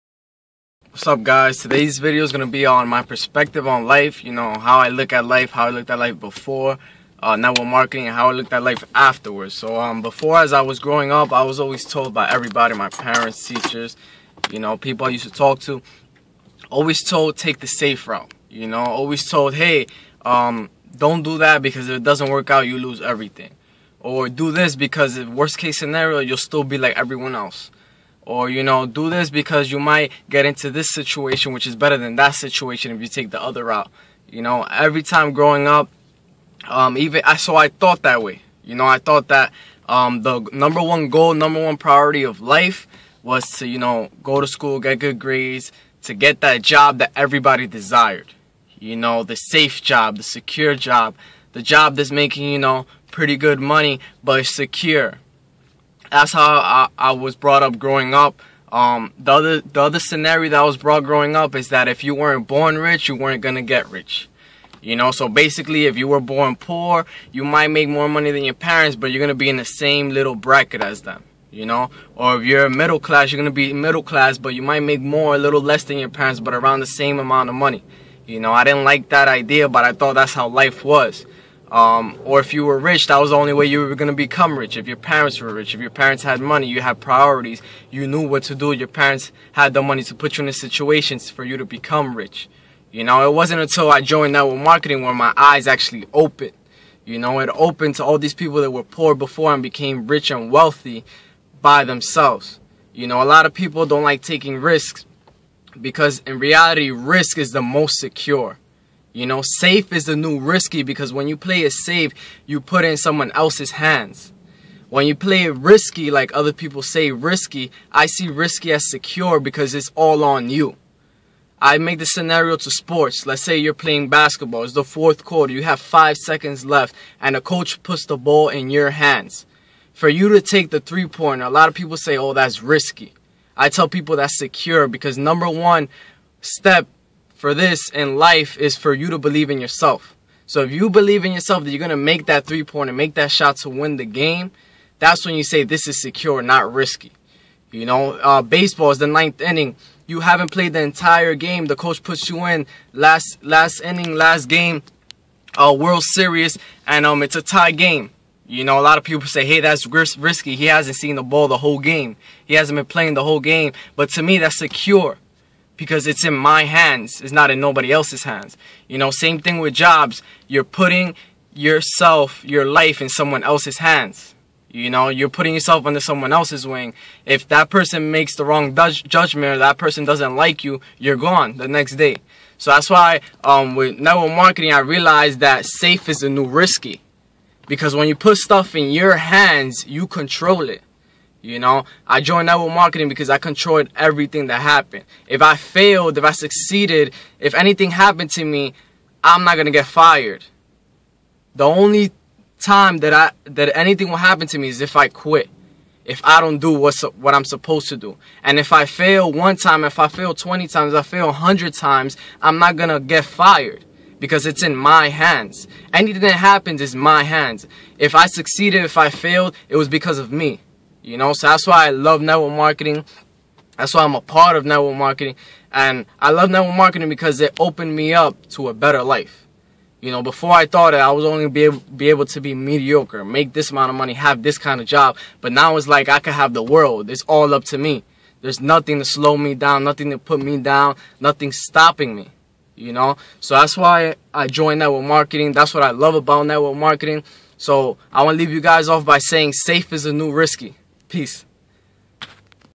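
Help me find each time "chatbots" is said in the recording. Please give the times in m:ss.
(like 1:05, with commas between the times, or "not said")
not said.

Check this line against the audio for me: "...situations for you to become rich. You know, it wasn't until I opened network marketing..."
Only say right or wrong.
wrong.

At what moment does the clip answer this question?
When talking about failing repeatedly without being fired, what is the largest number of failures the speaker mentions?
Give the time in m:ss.
3:31.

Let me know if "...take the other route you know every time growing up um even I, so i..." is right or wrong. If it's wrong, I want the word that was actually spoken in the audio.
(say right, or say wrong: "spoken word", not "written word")
right.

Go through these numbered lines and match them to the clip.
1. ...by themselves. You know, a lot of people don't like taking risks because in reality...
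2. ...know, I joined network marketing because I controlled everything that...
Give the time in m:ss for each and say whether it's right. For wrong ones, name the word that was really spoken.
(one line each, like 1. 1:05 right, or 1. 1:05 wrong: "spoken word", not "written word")
1. 1:41 right
2. 3:11 right.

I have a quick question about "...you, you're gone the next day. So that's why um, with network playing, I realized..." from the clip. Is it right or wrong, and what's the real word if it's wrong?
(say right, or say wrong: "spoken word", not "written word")
wrong: "marketing", not "playing".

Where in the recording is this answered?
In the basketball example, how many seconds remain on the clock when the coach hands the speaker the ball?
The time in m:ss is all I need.
2:05.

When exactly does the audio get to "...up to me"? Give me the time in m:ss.
3:57.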